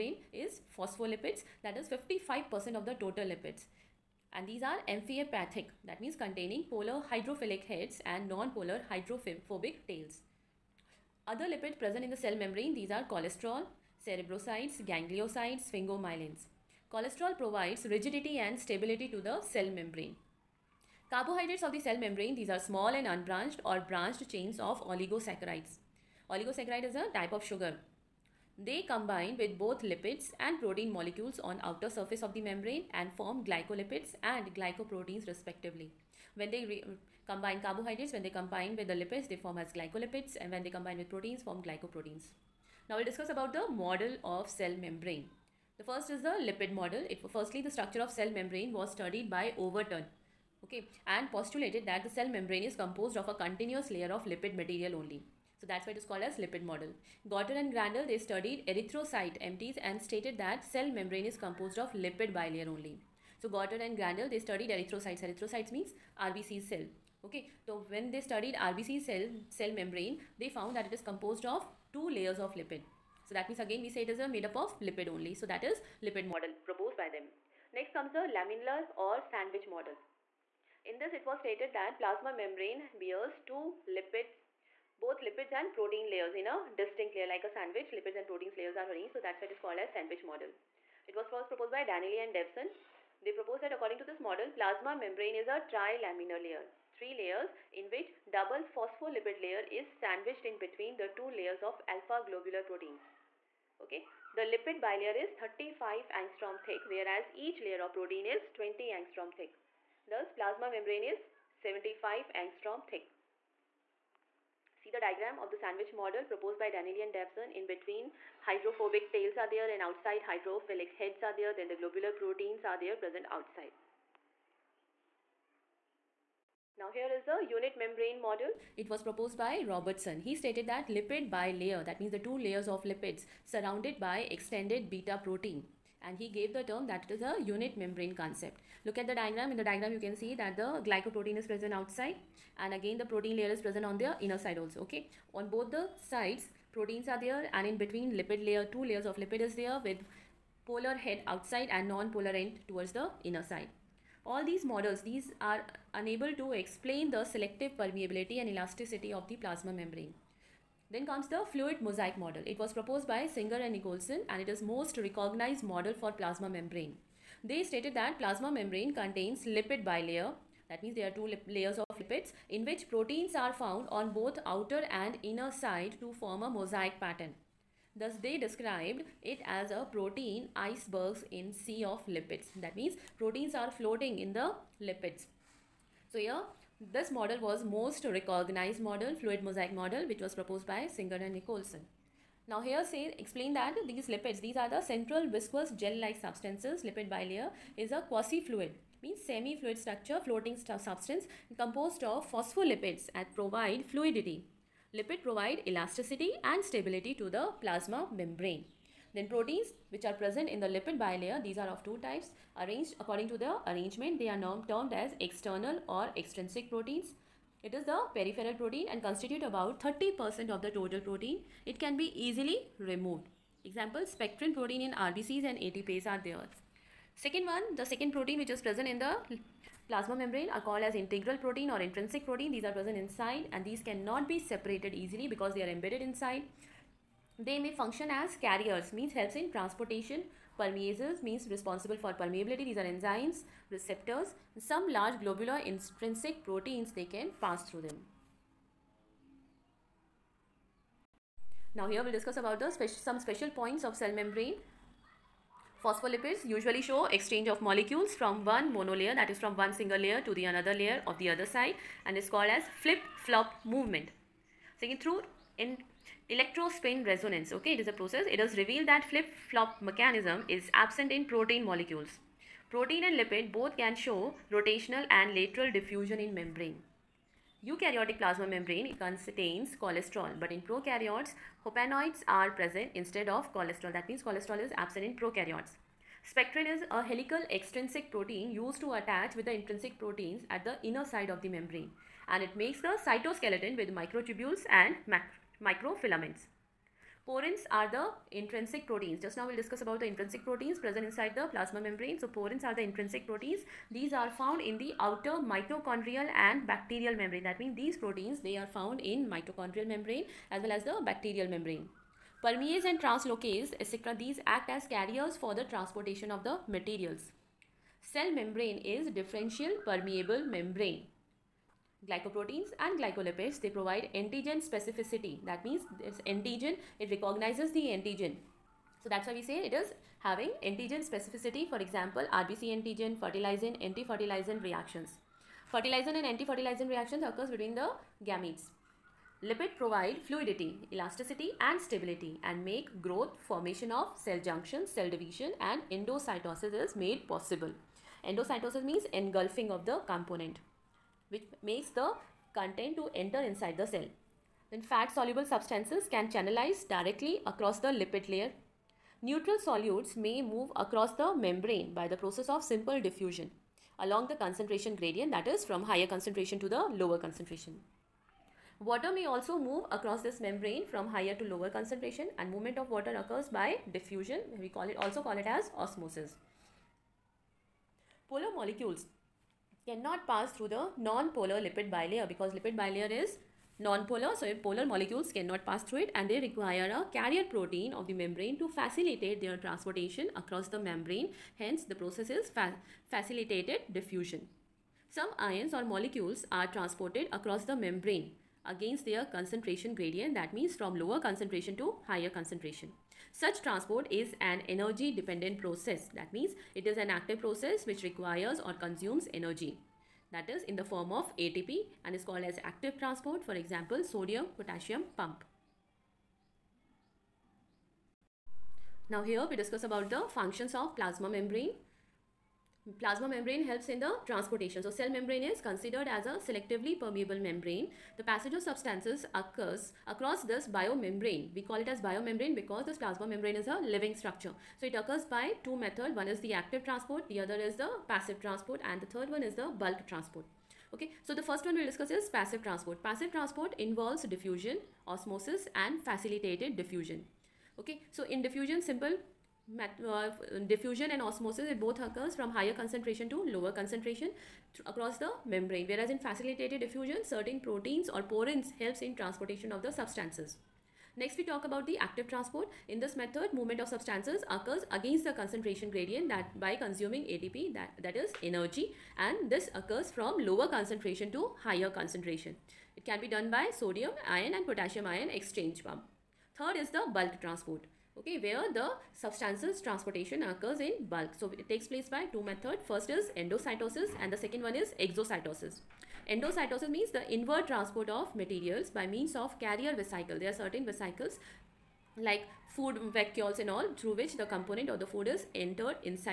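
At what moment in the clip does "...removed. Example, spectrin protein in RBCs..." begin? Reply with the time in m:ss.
3:42.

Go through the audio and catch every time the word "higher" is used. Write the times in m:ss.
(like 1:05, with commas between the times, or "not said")
6:05, 6:11, 6:42, 7:32, 7:51.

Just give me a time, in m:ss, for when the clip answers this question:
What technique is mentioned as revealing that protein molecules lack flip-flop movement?
4:26.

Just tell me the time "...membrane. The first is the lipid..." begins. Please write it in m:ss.
0:44.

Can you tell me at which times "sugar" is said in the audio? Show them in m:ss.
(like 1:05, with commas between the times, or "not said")
0:27.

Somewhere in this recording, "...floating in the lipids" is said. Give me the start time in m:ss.
3:03.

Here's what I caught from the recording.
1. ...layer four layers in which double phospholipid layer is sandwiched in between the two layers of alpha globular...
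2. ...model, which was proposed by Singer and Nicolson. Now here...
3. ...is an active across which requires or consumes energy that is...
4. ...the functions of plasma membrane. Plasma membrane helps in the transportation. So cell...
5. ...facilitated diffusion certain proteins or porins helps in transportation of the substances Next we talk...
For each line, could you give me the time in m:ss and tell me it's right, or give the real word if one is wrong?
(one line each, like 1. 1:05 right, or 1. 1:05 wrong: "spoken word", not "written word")
1. 1:36 wrong: "three", not "four"
2. 3:09 right
3. 6:46 wrong: "process", not "across"
4. 7:00 right
5. 7:36 right.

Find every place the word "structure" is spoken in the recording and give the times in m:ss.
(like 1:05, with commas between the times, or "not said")
0:47, 3:19, 7:14.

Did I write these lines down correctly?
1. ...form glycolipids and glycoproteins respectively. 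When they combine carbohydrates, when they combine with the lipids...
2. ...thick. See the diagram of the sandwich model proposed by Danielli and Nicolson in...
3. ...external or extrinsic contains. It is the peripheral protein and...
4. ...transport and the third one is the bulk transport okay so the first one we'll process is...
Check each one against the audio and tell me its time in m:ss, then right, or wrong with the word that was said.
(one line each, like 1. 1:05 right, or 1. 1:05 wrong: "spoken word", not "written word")
1. 0:33 right
2. 1:52 wrong: "Davson", not "Nicolson"
3. 3:35 wrong: "proteins", not "contains"
4. 7:18 wrong: "discuss", not "process".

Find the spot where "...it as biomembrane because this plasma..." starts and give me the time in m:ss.
7:11.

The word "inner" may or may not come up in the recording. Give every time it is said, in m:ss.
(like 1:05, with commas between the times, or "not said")
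2:24, 2:33, 2:55, 4:50.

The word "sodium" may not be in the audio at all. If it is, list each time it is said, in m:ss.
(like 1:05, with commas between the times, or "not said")
6:54, 7:53.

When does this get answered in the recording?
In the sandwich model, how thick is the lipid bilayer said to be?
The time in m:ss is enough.
1:45.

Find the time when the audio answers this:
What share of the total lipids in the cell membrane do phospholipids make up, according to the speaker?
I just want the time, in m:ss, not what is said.
0:01.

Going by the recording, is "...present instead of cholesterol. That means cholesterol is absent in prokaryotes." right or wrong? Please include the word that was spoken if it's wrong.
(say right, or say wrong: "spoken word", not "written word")
right.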